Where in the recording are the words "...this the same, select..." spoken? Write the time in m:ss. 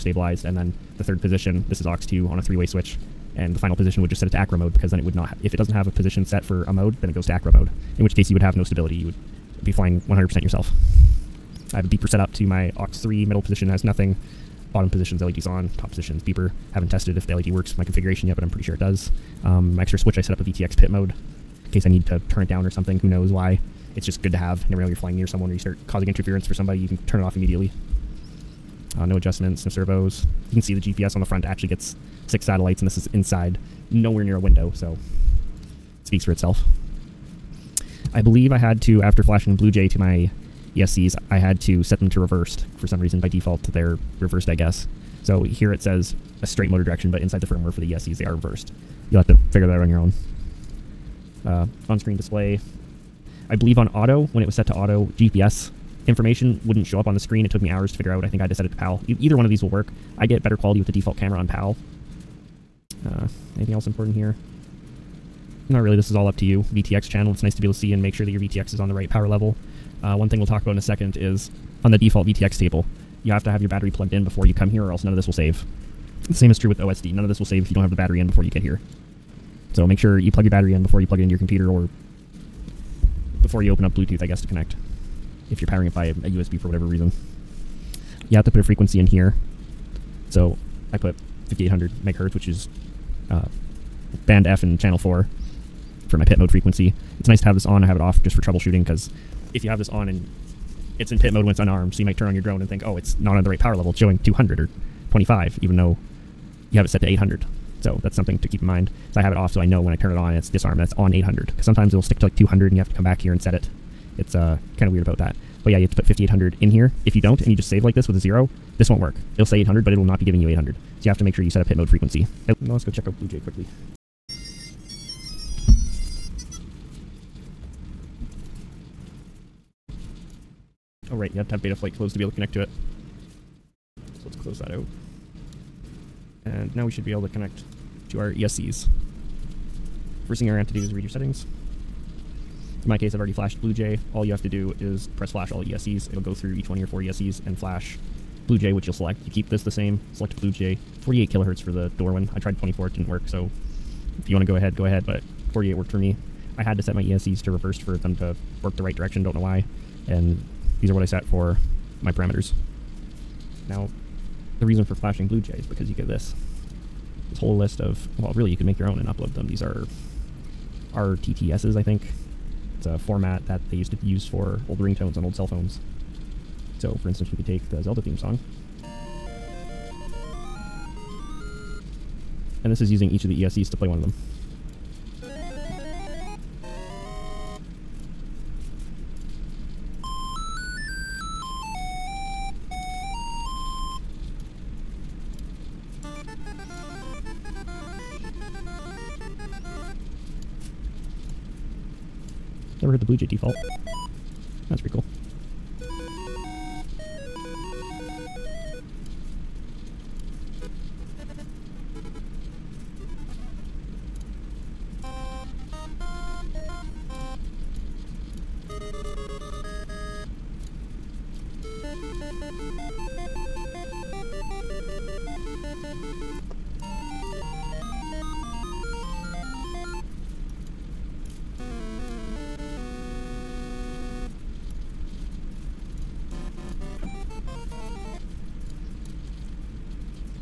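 2:29.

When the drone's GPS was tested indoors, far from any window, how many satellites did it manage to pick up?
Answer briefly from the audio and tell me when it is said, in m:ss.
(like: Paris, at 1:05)
6, at 0:32.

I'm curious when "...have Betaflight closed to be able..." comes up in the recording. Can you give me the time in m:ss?
2:11.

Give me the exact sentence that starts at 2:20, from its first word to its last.
First thing you're going to have to do is read your settings.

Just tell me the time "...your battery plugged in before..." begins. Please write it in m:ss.
1:13.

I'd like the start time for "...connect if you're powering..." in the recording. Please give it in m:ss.
1:24.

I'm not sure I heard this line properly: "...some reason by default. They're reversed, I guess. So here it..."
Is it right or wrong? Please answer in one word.
right.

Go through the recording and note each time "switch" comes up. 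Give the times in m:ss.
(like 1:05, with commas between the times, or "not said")
0:02, 0:19.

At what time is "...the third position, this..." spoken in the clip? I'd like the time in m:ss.
0:00.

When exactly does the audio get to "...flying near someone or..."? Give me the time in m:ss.
0:24.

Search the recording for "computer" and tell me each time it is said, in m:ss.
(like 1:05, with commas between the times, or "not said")
1:21.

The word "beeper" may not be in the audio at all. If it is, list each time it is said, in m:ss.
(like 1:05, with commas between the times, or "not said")
0:11, 0:16.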